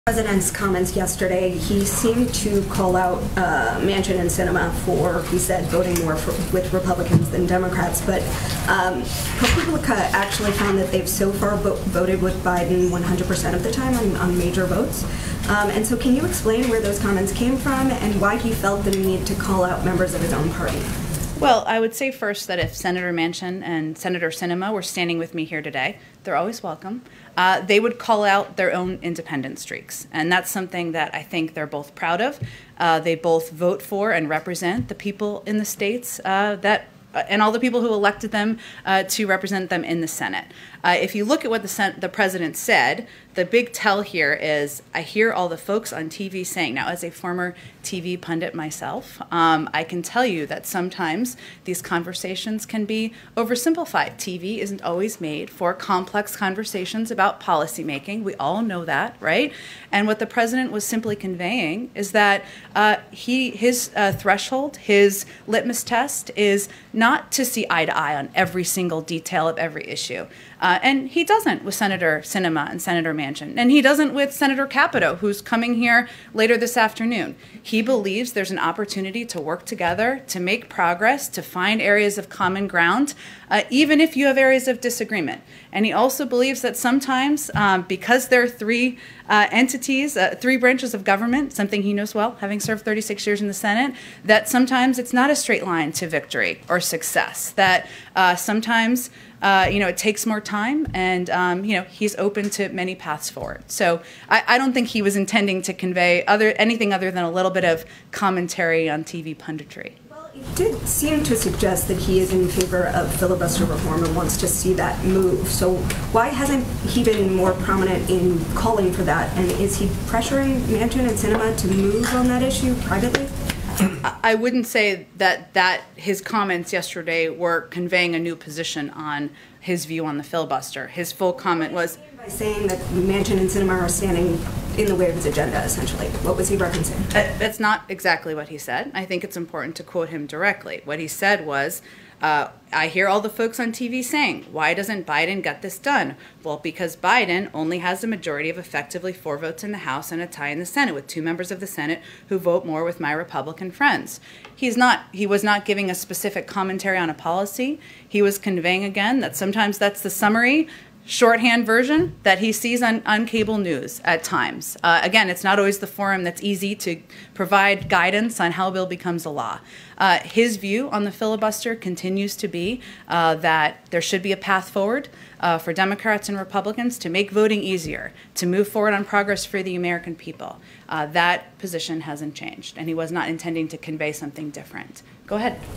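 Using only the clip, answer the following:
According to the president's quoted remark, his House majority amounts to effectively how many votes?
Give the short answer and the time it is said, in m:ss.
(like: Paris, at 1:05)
4, at 2:29.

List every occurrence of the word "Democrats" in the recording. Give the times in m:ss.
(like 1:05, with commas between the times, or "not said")
0:07, 2:55.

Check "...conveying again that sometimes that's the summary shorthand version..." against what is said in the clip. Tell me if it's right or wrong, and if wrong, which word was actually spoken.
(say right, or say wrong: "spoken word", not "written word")
right.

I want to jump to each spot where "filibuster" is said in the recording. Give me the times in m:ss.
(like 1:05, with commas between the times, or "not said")
1:53, 2:10, 2:51.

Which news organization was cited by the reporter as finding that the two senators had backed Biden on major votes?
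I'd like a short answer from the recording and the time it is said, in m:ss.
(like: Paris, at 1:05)
ProPublica, at 0:09.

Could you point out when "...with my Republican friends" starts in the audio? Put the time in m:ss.
2:32.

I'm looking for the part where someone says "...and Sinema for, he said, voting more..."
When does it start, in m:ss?
0:04.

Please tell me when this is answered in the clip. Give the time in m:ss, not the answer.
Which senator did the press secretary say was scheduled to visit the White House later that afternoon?
1:14.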